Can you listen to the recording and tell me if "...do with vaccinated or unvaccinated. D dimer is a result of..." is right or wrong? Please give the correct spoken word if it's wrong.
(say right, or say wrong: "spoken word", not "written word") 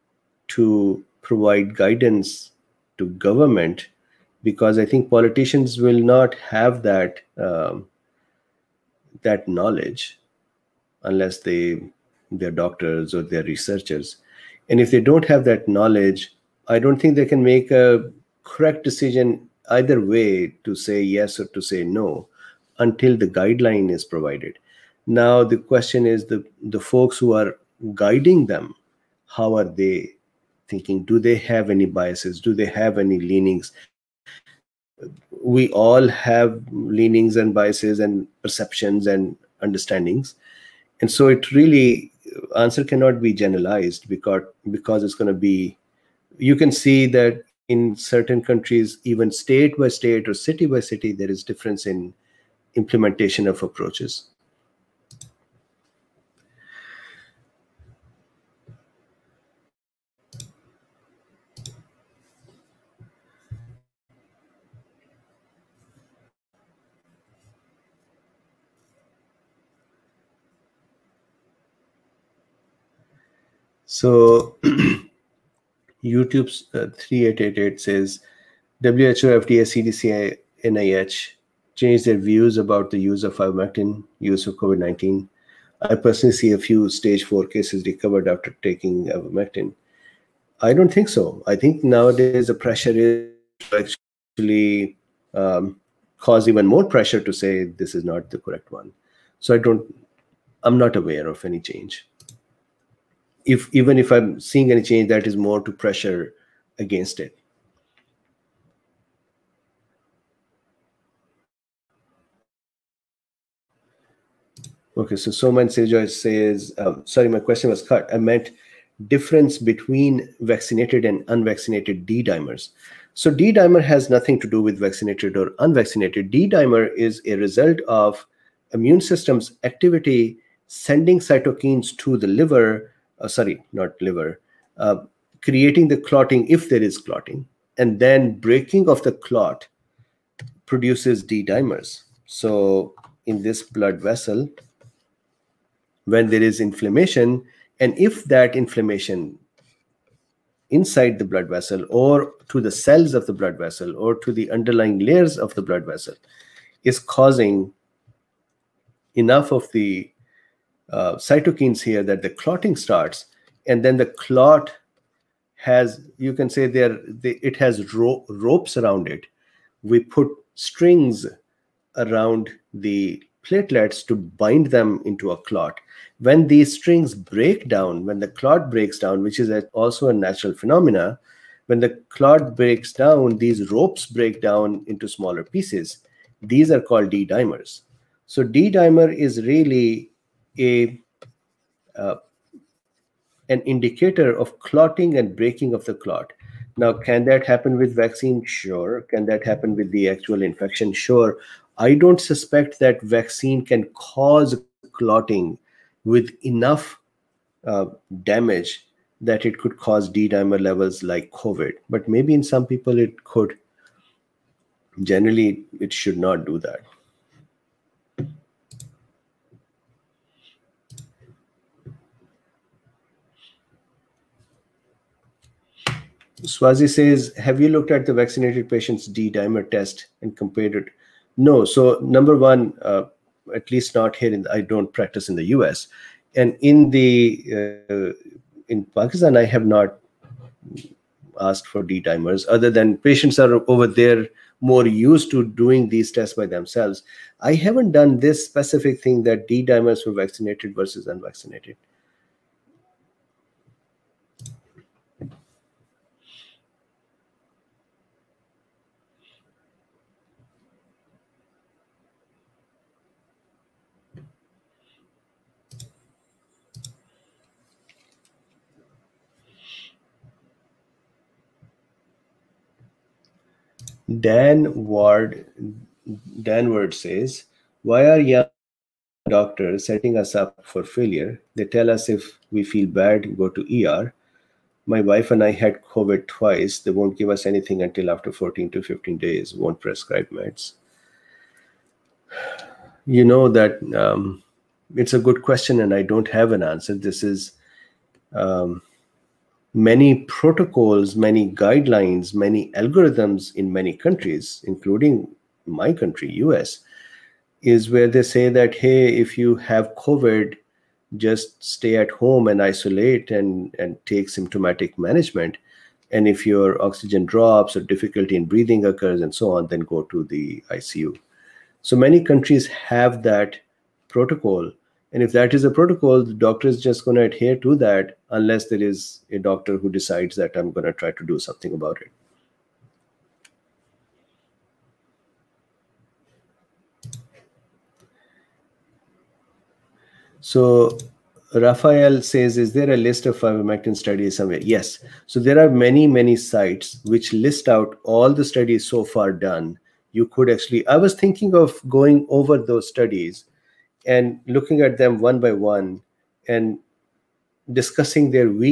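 right.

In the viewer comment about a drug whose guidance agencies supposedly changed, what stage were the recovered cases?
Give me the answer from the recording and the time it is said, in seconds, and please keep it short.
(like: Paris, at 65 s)
Stage four, at 86 s.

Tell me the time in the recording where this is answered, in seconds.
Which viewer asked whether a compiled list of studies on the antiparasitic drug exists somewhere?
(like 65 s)
341 s.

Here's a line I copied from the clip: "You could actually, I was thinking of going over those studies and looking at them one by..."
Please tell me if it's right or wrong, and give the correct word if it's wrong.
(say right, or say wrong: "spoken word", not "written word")
right.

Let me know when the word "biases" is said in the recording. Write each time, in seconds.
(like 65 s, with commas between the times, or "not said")
31 s, 37 s.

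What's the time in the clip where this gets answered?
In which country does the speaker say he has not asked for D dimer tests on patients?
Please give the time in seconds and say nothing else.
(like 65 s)
238 s.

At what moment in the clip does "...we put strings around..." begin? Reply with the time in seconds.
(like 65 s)
169 s.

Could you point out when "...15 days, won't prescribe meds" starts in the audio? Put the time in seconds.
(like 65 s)
288 s.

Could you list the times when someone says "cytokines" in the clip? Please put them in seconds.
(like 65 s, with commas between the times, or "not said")
131 s, 161 s.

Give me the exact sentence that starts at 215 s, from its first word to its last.
Generally, it should not do that.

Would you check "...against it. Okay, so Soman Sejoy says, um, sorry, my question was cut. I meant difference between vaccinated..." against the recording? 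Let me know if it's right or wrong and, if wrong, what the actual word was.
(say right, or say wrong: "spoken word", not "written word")
right.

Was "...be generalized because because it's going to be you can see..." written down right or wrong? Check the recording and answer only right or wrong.
right.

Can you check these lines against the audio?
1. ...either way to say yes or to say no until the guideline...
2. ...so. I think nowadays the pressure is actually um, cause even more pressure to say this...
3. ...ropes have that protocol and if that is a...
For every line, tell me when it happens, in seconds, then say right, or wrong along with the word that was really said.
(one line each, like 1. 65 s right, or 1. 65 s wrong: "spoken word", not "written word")
1. 19 s right
2. 91 s right
3. 322 s wrong: "countries", not "ropes".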